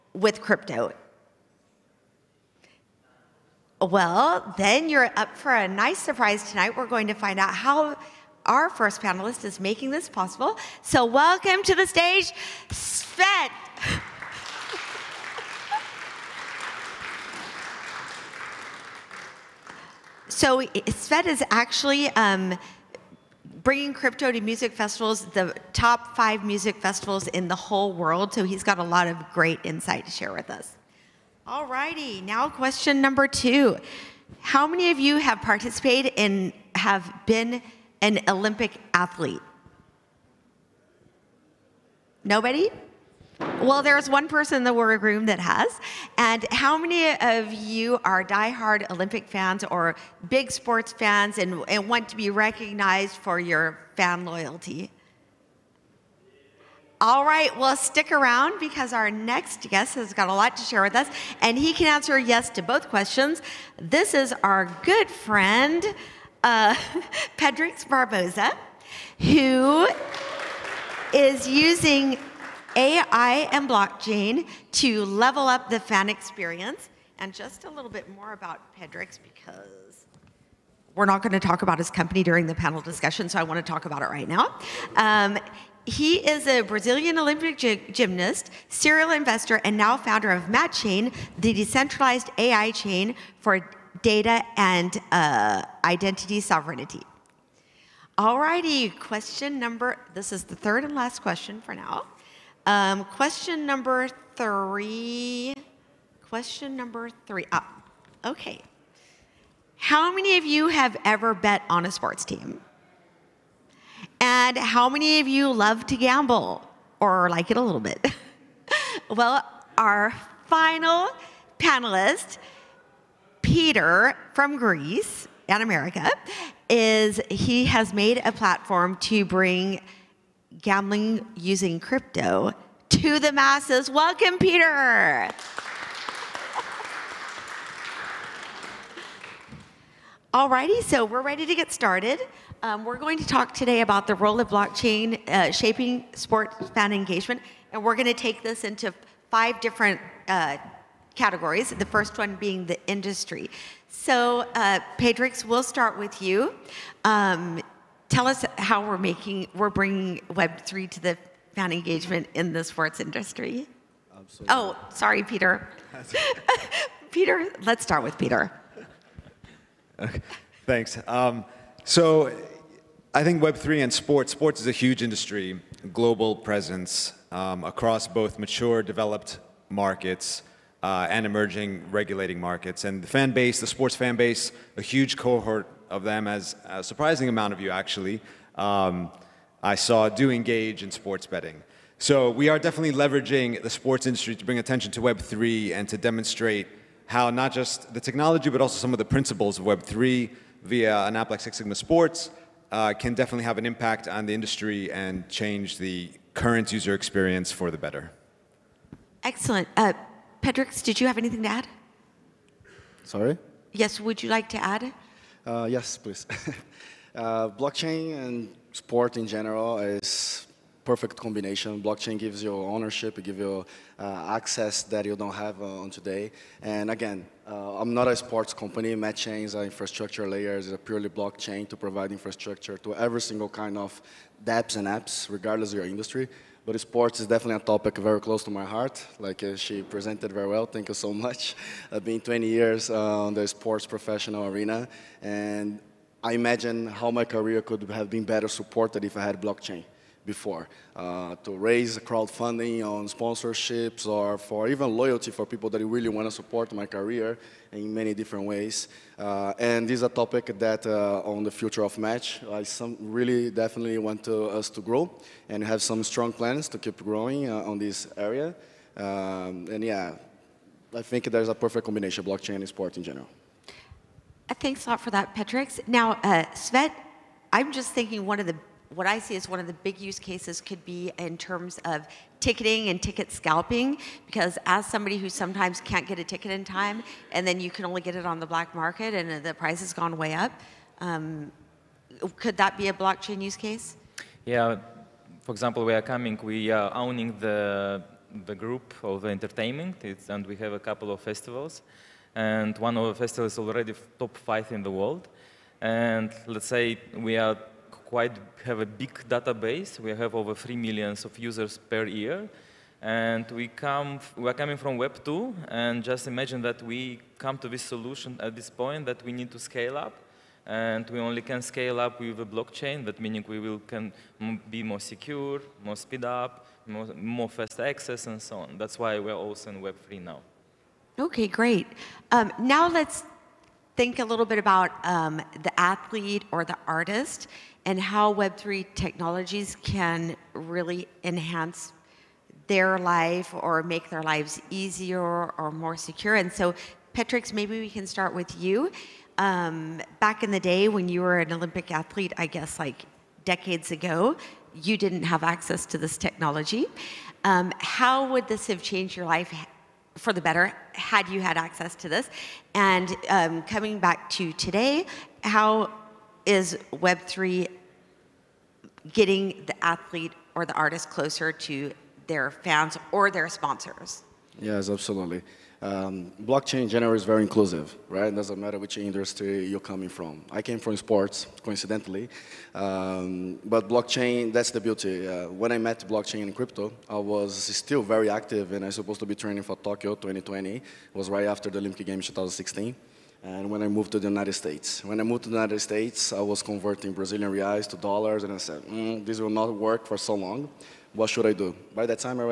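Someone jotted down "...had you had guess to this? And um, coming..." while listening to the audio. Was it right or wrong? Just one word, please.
wrong.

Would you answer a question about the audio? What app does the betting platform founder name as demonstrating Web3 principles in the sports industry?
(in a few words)
Six Sigma Sports.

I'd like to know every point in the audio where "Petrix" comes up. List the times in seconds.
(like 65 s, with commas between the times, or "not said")
67 s, 78 s, 154 s, 210 s, 275 s, 347 s.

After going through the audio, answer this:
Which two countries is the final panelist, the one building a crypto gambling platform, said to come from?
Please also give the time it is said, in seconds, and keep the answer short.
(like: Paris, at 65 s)
Greece and America, at 124 s.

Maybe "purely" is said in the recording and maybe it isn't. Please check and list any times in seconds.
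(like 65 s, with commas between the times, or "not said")
230 s.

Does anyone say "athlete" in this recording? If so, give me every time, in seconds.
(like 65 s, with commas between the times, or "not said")
38 s, 335 s, 351 s, 369 s.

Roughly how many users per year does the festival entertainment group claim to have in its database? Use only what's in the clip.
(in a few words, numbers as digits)
over 3 million.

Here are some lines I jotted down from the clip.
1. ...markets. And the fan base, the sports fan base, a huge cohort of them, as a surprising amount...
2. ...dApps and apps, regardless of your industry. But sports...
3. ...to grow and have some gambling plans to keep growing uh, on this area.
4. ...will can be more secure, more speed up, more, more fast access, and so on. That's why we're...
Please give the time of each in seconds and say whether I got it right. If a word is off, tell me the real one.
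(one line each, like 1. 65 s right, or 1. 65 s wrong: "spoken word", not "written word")
1. 182 s right
2. 234 s right
3. 264 s wrong: "strong", not "gambling"
4. 323 s right.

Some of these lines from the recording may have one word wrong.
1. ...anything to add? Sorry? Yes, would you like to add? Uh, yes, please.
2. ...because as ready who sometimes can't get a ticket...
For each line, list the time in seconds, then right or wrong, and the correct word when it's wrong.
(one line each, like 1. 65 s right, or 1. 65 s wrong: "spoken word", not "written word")
1. 211 s right
2. 284 s wrong: "somebody", not "ready".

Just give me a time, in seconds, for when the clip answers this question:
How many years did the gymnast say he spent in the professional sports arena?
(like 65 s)
242 s.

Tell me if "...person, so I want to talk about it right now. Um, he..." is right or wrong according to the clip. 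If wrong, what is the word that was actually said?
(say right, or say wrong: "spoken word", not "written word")
wrong: "discussion", not "person".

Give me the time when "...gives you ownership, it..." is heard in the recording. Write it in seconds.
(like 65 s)
222 s.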